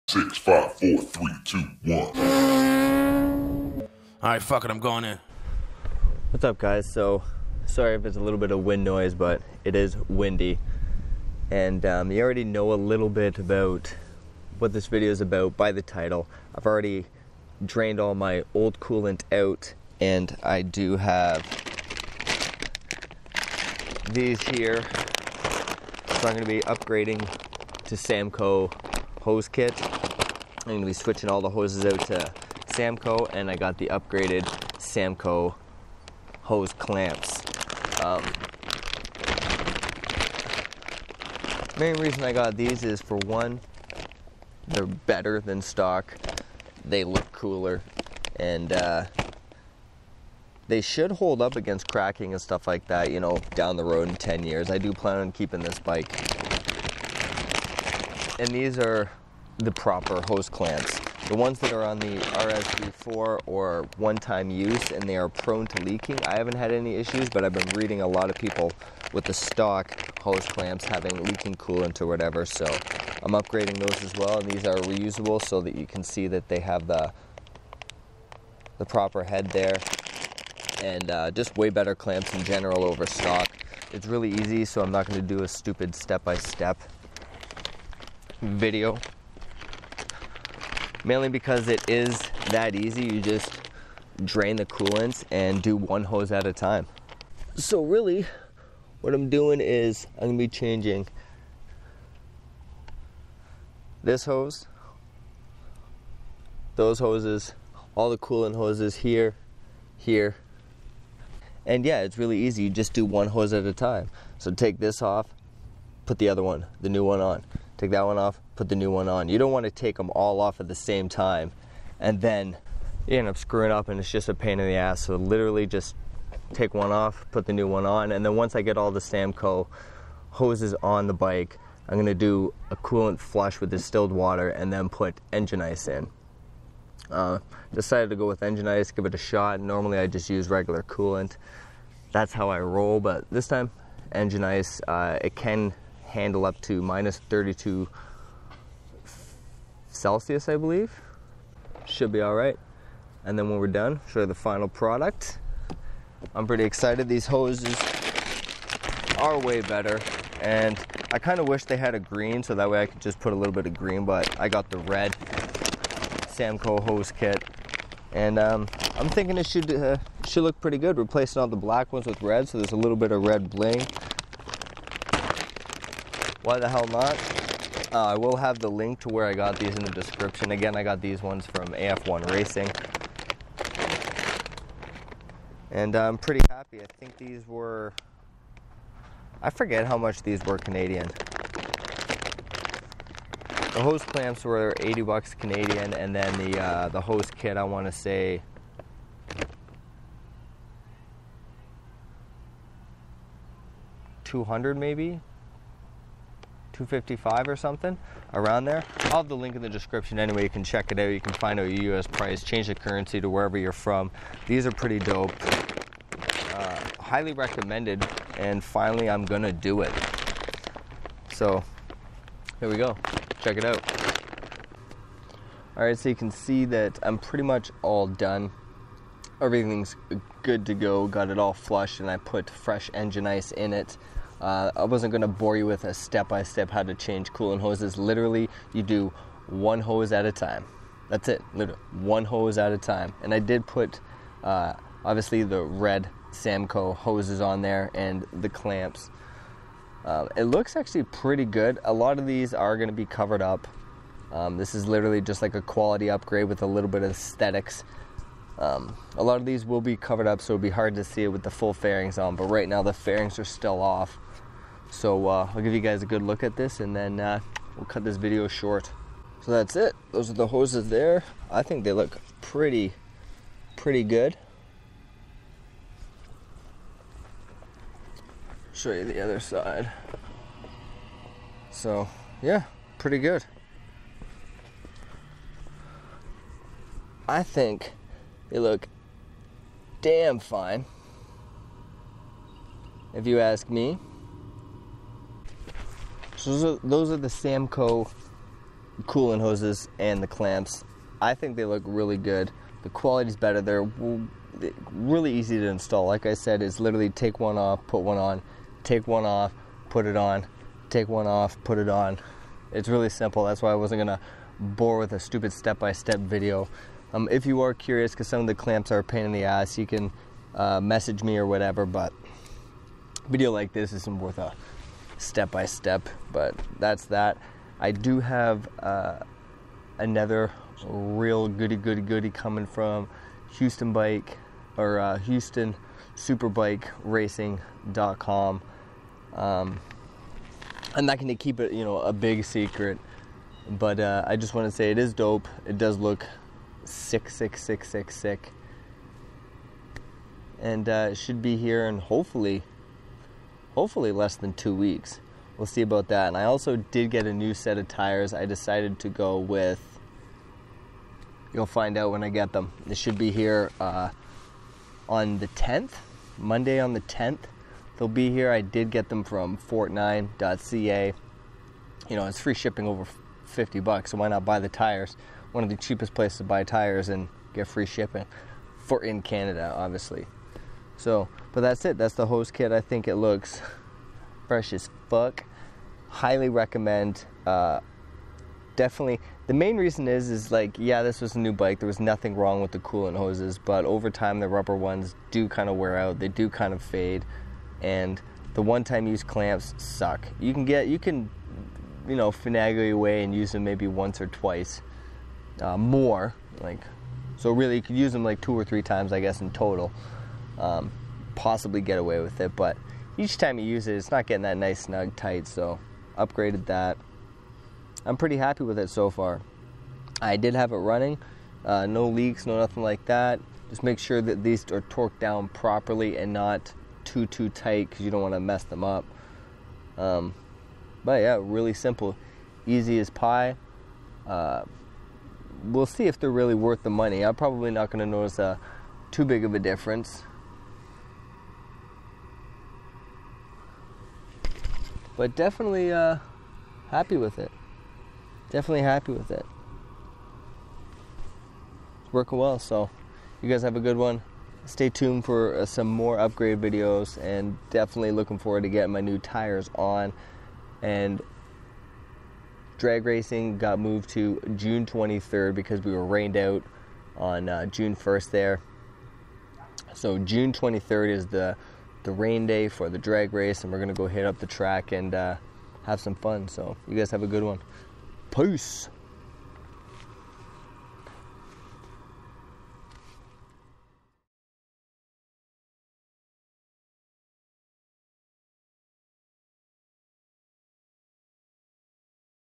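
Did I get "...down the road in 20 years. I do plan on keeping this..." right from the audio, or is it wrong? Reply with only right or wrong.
wrong.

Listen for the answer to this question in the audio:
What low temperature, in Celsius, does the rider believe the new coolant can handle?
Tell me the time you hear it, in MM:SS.
02:26.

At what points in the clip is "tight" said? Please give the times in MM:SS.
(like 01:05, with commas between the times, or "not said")
06:55, 07:07.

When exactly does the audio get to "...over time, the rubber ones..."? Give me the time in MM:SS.
06:33.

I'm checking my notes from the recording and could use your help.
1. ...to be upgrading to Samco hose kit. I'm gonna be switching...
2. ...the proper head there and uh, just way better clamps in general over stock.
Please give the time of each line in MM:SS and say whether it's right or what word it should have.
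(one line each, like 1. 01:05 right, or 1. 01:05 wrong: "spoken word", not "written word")
1. 00:26 right
2. 01:18 right.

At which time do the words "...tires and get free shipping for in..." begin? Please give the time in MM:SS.
06:16.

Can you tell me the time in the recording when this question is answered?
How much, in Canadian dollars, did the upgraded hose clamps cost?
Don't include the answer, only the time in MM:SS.
03:14.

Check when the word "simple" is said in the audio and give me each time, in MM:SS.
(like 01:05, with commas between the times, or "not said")
05:13, 07:11.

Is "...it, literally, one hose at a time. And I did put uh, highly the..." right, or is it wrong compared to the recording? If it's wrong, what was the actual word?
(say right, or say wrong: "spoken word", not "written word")
wrong: "obviously", not "highly".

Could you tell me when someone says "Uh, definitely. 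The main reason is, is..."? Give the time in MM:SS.
06:27.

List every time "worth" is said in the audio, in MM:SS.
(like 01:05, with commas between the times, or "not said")
05:24, 07:16.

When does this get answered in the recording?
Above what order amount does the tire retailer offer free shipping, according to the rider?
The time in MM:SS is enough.
06:13.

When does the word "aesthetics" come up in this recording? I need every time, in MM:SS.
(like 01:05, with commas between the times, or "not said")
04:17.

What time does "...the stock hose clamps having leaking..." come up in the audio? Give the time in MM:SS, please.
01:09.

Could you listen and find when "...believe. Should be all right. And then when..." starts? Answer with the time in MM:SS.
02:30.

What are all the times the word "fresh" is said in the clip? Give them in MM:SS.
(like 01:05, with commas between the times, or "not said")
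03:52, 06:24.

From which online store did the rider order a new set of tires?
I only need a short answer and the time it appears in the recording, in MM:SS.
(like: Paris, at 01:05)
Fortnine.ca, at 06:09.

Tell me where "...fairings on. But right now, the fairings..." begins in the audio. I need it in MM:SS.
04:21.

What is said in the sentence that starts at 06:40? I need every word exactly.
You can get, you can, you know, finagle your way and use them maybe once or twice uh, more.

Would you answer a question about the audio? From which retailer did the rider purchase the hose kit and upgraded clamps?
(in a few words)
AF1 Racing.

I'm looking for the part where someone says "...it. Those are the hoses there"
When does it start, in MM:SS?
04:29.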